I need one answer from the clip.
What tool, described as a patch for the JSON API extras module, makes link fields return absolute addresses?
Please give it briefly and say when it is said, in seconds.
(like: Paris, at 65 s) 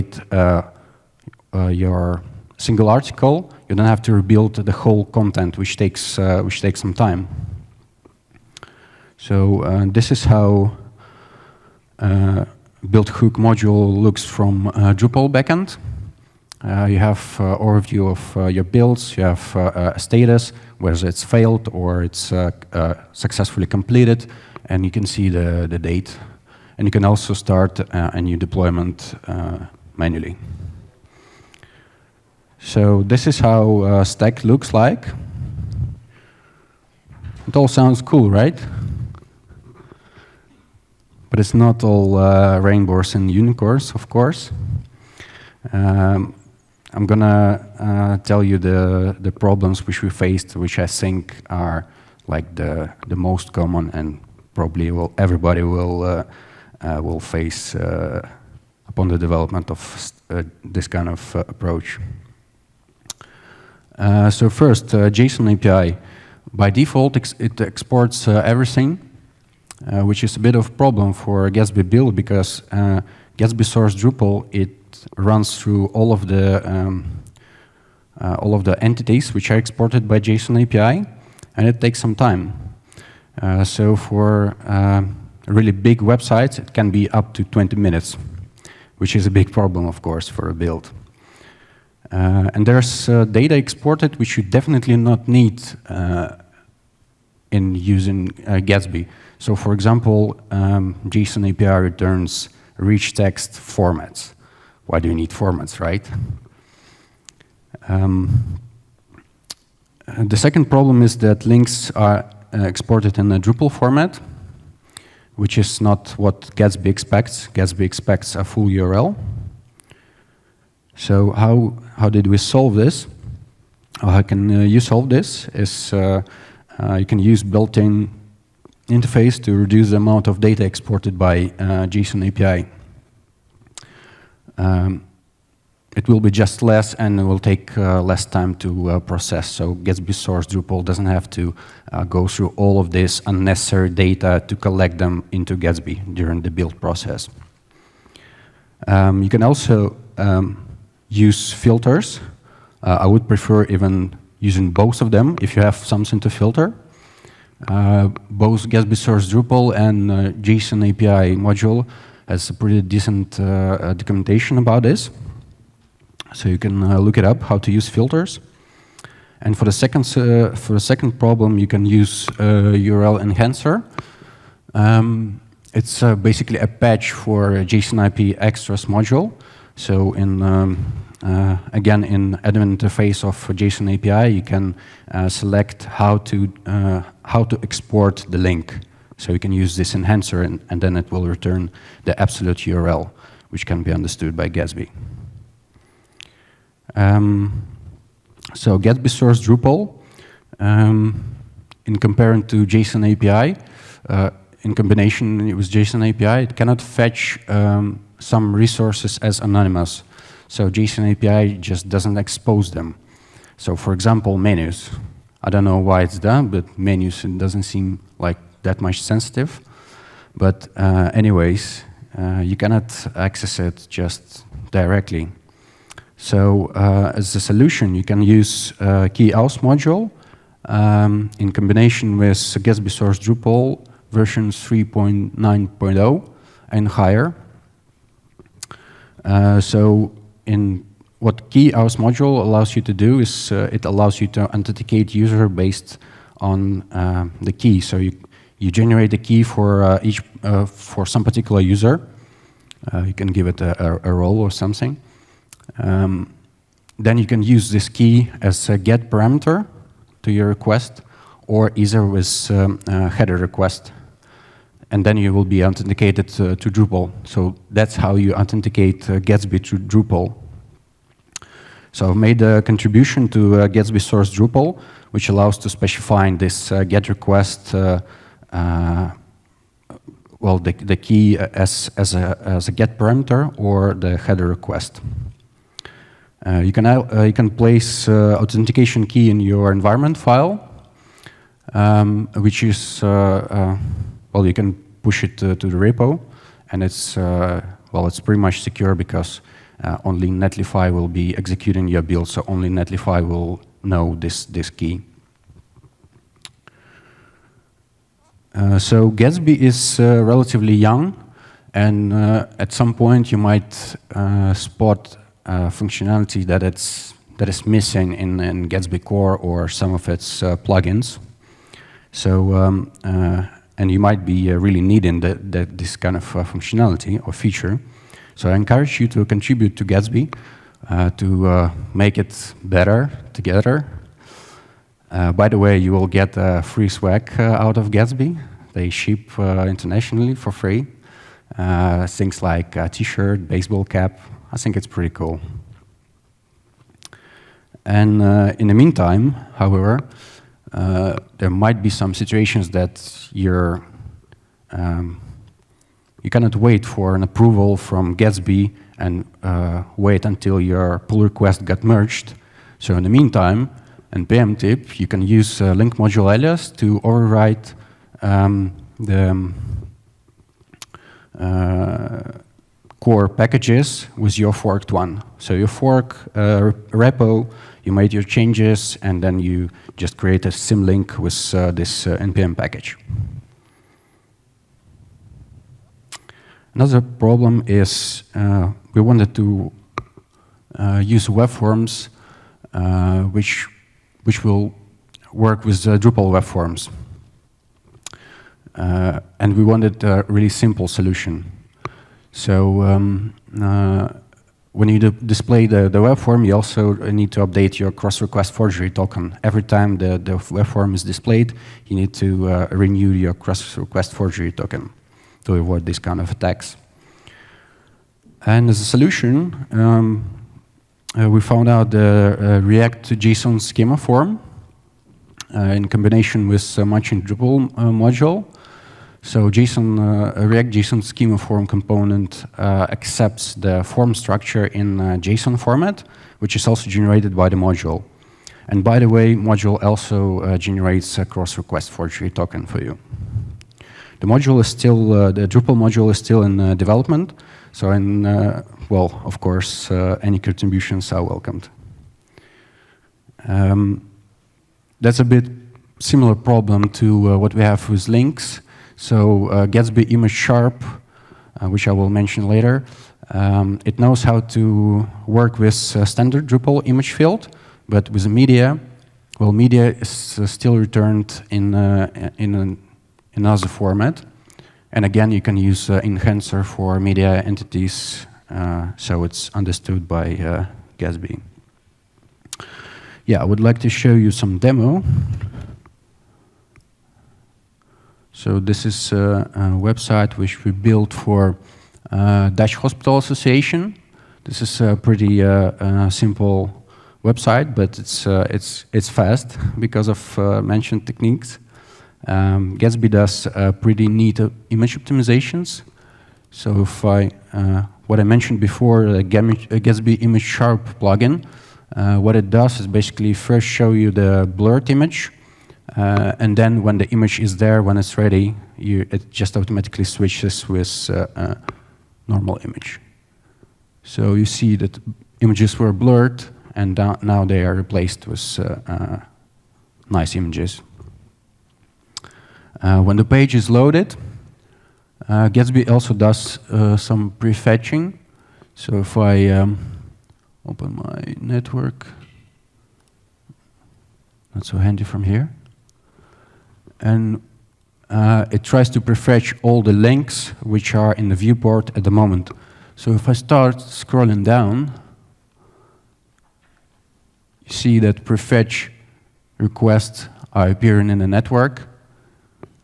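URL enhancer, at 172 s.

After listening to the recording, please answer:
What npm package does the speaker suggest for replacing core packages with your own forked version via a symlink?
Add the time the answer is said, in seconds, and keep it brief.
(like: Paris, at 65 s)
link module alias, at 365 s.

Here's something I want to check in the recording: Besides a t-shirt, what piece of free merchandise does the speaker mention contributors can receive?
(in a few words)
baseball cap.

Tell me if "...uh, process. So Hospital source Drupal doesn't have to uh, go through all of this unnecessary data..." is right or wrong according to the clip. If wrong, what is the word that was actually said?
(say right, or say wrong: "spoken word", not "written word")
wrong: "Gatsby", not "Hospital".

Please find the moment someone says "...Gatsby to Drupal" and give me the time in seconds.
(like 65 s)
269 s.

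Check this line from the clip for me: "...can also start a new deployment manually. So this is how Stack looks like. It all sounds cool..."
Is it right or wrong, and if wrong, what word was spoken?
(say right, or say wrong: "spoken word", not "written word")
right.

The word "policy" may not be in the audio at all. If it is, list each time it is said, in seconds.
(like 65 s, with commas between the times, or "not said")
not said.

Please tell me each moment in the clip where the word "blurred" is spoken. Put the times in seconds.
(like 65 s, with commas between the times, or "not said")
514 s, 525 s.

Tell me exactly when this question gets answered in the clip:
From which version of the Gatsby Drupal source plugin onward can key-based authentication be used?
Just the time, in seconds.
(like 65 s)
234 s.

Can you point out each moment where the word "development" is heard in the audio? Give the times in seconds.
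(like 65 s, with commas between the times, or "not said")
59 s, 446 s.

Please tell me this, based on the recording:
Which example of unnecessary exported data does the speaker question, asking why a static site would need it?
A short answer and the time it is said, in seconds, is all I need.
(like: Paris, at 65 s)
rich text formats, at 102 s.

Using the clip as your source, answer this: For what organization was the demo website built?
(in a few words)
Dutch Hospital Association.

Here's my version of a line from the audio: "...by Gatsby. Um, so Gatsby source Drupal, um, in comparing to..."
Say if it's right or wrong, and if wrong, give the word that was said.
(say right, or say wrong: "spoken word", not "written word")
right.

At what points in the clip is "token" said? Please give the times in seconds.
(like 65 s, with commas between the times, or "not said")
408 s, 414 s, 442 s.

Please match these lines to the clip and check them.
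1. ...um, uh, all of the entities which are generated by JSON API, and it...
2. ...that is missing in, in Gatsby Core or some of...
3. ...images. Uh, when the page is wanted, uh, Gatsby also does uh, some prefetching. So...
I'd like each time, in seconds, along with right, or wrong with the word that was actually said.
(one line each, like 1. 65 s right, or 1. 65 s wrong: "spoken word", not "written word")
1. 76 s wrong: "exported", not "generated"
2. 317 s right
3. 530 s wrong: "loaded", not "wanted".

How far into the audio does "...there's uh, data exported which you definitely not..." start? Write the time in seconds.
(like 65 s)
92 s.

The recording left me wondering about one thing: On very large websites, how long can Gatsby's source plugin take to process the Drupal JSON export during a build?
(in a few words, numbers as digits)
20 minutes.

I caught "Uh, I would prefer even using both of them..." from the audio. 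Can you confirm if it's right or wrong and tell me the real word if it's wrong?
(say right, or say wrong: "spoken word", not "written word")
right.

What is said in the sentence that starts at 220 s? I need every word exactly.
But uh, anyways, uh, you cannot access it just directly.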